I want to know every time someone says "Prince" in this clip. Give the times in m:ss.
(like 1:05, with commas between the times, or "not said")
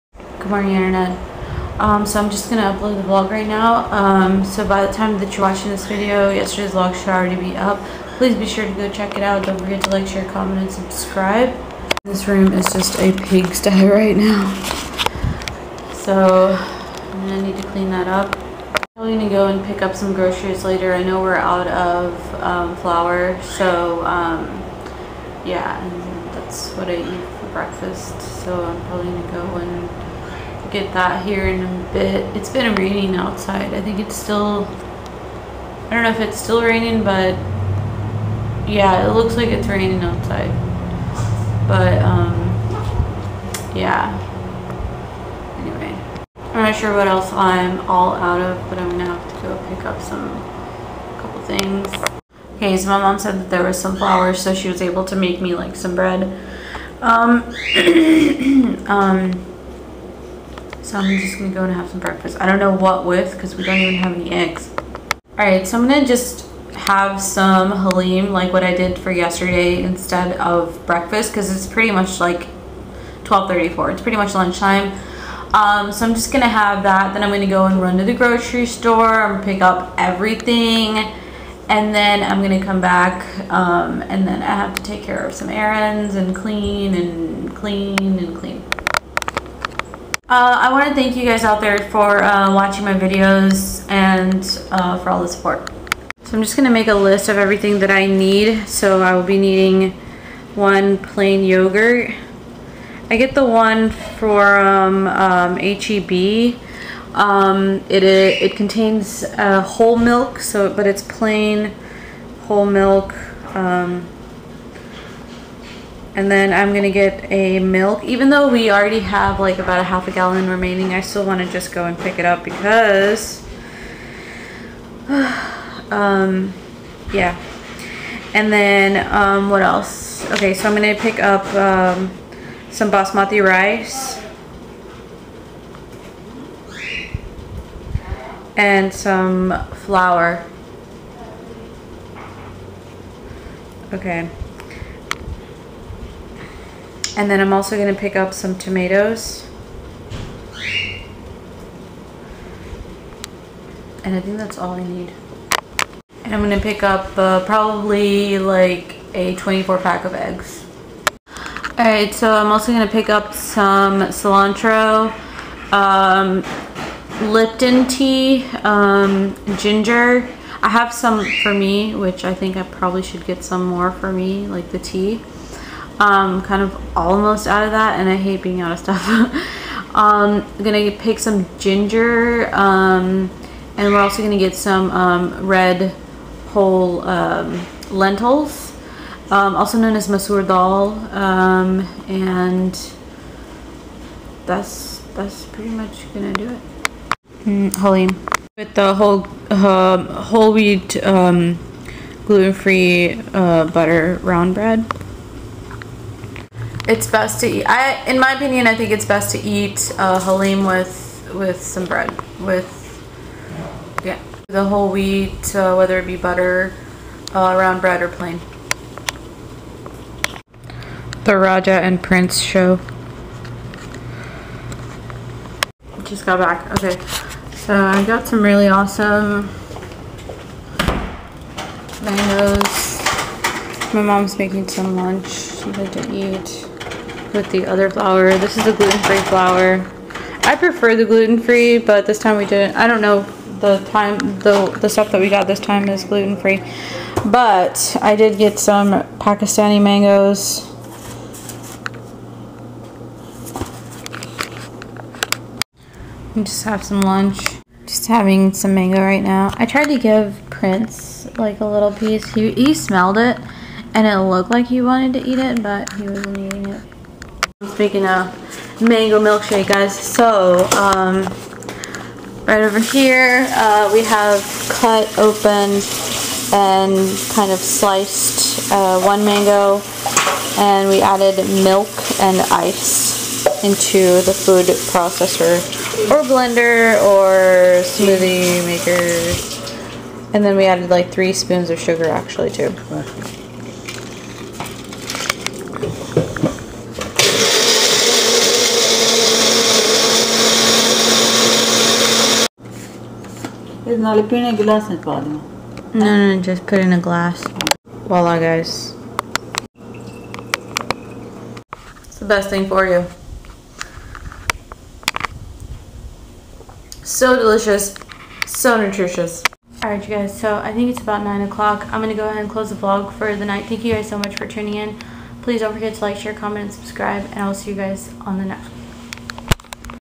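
3:42, 4:20.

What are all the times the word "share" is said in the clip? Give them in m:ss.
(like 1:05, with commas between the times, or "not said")
0:10, 5:26.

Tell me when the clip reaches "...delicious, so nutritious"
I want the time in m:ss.
5:17.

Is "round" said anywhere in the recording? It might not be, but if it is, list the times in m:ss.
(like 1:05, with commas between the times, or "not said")
3:24, 3:37.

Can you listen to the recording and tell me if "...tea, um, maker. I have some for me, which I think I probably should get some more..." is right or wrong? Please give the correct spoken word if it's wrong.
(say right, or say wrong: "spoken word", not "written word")
wrong: "ginger", not "maker".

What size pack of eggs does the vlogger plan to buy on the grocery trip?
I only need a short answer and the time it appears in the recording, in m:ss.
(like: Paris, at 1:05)
24, at 2:39.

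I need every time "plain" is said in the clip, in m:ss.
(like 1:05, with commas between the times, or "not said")
1:40, 1:51, 3:38.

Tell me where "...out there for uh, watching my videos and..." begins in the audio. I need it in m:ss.
1:31.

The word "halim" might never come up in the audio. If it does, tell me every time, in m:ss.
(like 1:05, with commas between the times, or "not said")
1:07, 3:30.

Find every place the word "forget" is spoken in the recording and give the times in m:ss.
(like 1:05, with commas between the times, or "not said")
0:09, 5:25.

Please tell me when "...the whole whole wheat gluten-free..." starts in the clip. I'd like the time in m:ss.
3:18.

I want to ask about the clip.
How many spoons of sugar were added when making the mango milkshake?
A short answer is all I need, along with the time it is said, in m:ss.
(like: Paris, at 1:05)
3, at 4:51.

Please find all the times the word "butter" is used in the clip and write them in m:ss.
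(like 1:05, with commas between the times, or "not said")
3:23, 3:36.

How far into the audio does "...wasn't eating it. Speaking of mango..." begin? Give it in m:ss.
4:26.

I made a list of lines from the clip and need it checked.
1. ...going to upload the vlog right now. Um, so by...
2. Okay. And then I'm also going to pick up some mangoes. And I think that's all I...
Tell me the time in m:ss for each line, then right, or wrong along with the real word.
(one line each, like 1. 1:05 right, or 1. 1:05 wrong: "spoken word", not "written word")
1. 0:02 right
2. 2:23 wrong: "tomatoes", not "mangoes".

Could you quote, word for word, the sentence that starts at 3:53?
My mom's making some lunch, something to eat with the other flour.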